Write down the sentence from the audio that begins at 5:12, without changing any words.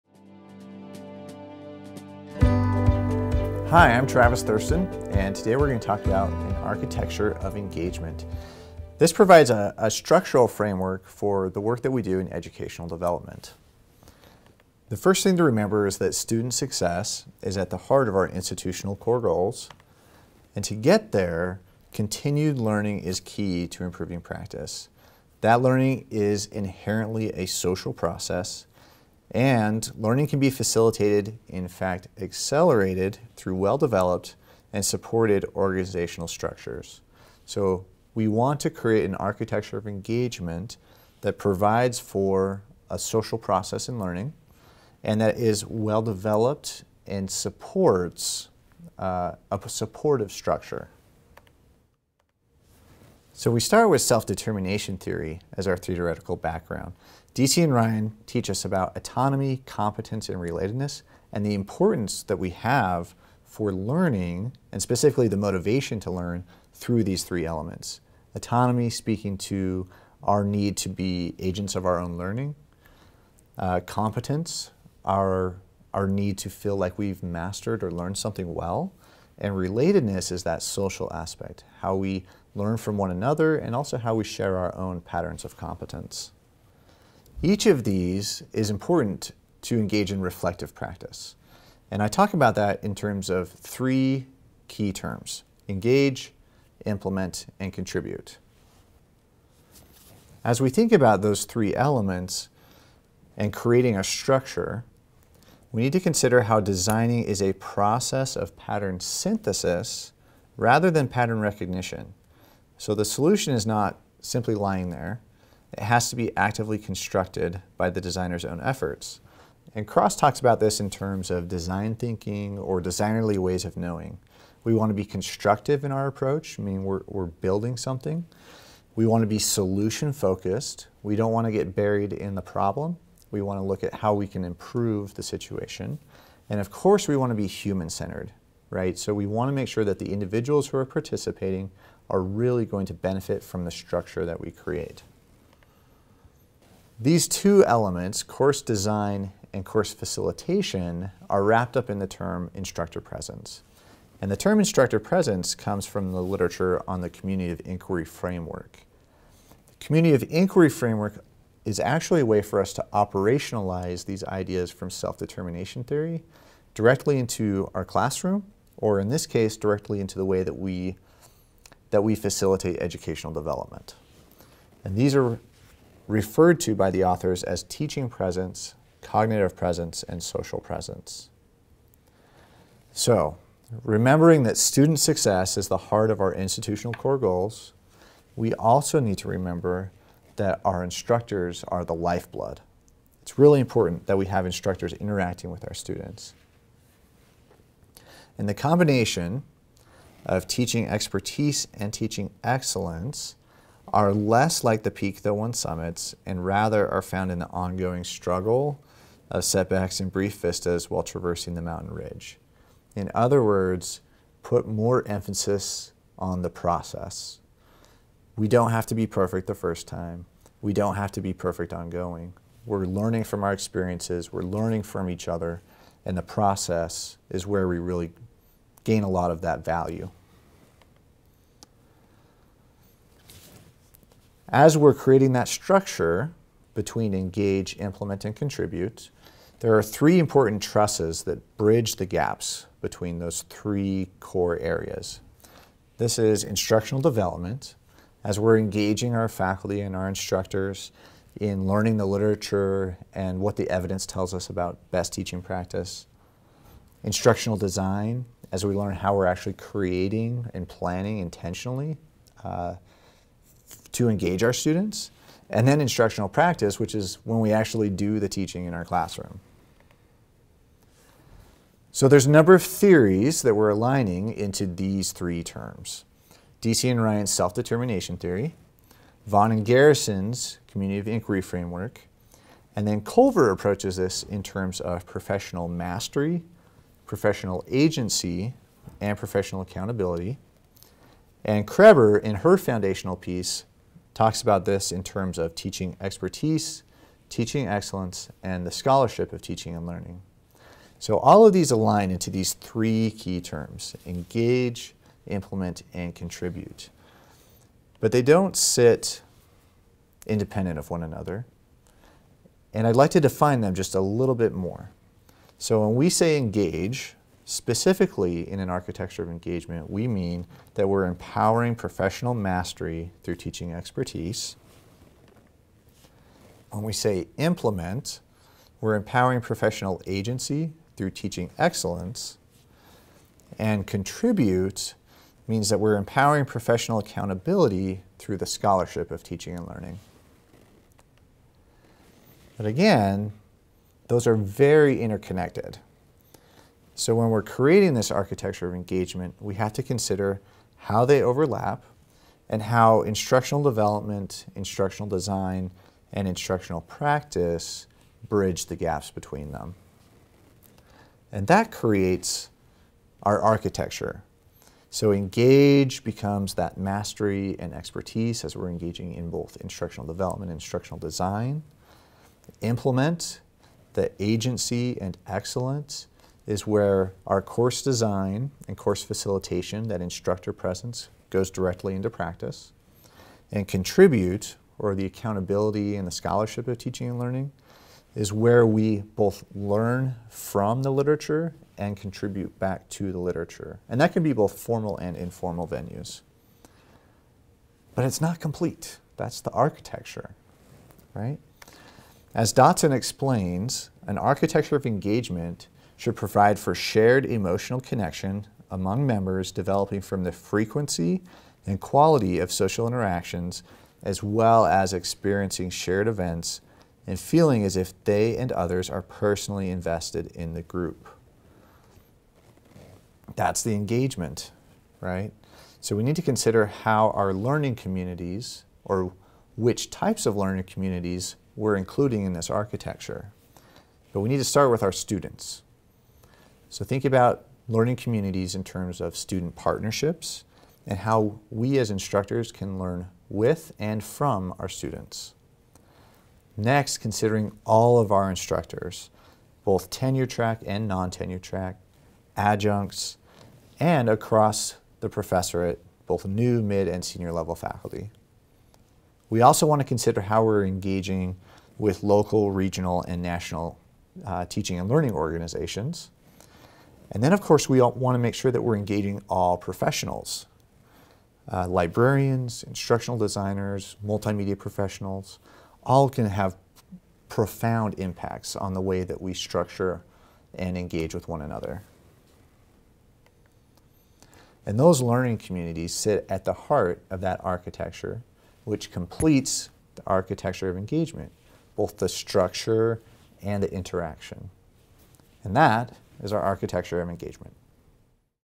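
And I'd like to define them just a little bit more.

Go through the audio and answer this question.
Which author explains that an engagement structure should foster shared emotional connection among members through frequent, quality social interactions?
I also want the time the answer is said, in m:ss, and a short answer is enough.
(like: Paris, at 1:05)
Dotson, at 6:42.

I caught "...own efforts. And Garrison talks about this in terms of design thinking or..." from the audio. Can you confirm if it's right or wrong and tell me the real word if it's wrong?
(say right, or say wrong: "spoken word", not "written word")
wrong: "Cross", not "Garrison".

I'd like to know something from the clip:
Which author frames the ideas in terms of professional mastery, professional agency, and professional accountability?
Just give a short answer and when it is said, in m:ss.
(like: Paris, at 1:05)
Culver, at 4:43.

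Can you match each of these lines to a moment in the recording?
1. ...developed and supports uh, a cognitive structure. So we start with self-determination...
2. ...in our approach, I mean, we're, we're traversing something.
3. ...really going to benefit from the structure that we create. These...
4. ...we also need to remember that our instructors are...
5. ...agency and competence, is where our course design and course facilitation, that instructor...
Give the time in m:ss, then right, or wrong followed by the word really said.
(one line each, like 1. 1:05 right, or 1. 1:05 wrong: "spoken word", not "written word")
1. 0:46 wrong: "supportive", not "cognitive"
2. 2:05 wrong: "building", not "traversing"
3. 2:22 right
4. 3:08 right
5. 6:14 wrong: "excellence", not "competence".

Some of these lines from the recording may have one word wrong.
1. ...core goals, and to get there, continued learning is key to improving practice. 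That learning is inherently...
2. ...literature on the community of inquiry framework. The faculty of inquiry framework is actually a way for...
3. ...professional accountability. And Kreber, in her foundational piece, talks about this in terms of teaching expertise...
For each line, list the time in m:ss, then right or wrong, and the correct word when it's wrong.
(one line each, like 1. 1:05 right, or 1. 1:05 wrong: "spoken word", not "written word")
1. 0:18 right
2. 2:36 wrong: "community", not "faculty"
3. 4:49 right.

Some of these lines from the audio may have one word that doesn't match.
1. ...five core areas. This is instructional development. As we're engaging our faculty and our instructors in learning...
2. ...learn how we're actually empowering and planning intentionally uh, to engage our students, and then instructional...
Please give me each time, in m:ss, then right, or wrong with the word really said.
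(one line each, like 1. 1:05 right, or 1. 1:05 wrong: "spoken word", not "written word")
1. 4:03 wrong: "three", not "five"
2. 4:18 wrong: "creating", not "empowering".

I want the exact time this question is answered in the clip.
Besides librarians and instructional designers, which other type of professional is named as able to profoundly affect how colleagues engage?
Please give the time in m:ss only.
7:54.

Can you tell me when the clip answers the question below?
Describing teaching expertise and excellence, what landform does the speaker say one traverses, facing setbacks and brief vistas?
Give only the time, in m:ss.
3:31.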